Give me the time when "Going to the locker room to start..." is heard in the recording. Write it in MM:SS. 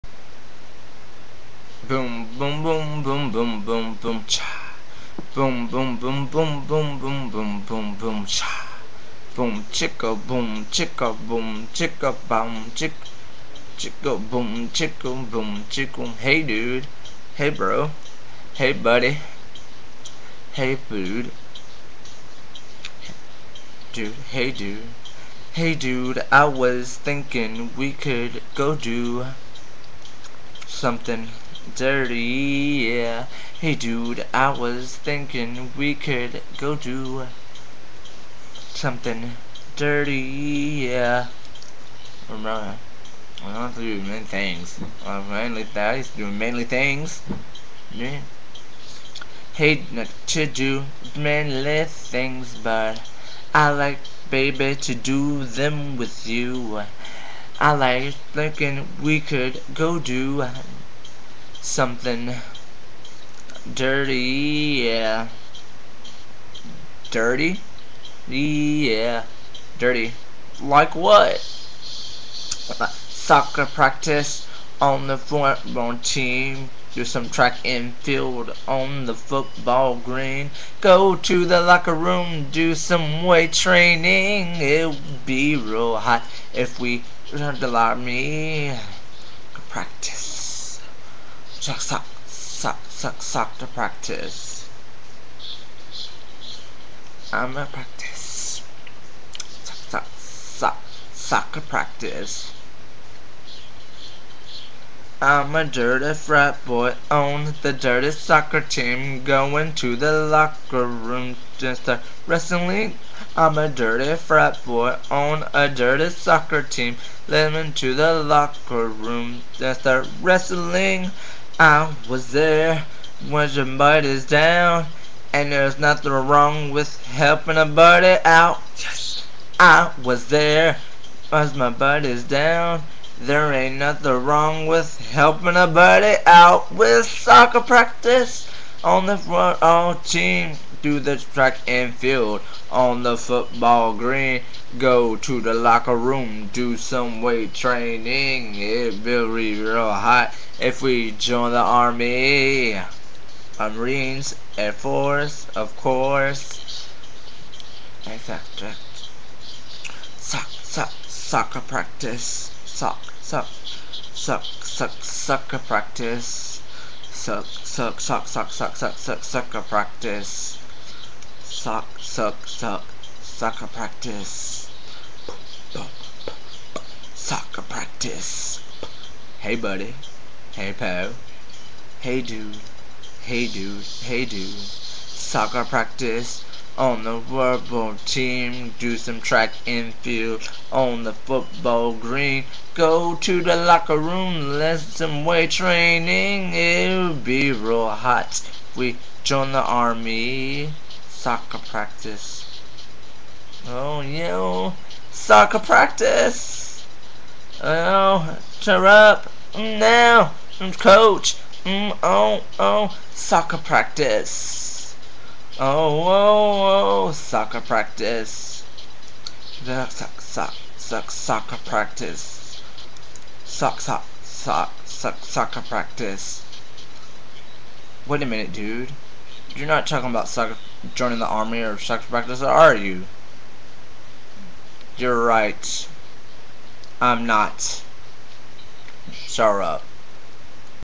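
01:49.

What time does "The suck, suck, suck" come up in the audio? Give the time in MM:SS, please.
03:39.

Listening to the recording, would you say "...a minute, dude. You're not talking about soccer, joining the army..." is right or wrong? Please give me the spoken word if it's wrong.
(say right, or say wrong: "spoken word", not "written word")
right.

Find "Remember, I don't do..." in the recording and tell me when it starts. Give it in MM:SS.
00:42.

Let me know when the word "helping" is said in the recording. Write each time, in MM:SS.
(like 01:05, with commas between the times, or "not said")
02:07, 02:15.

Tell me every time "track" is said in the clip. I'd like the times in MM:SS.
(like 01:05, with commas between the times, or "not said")
01:17, 02:21, 03:09.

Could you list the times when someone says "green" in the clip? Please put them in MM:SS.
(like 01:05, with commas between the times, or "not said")
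01:19, 02:23, 03:11.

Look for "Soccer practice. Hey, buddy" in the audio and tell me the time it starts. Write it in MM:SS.
02:57.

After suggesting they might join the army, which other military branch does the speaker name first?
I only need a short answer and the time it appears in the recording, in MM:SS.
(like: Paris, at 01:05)
Marines, at 02:33.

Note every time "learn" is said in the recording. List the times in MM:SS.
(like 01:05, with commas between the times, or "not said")
01:27.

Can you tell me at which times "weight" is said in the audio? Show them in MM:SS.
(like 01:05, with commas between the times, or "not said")
01:23, 02:27, 03:15.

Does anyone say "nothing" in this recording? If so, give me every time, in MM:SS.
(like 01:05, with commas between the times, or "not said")
02:05, 02:13.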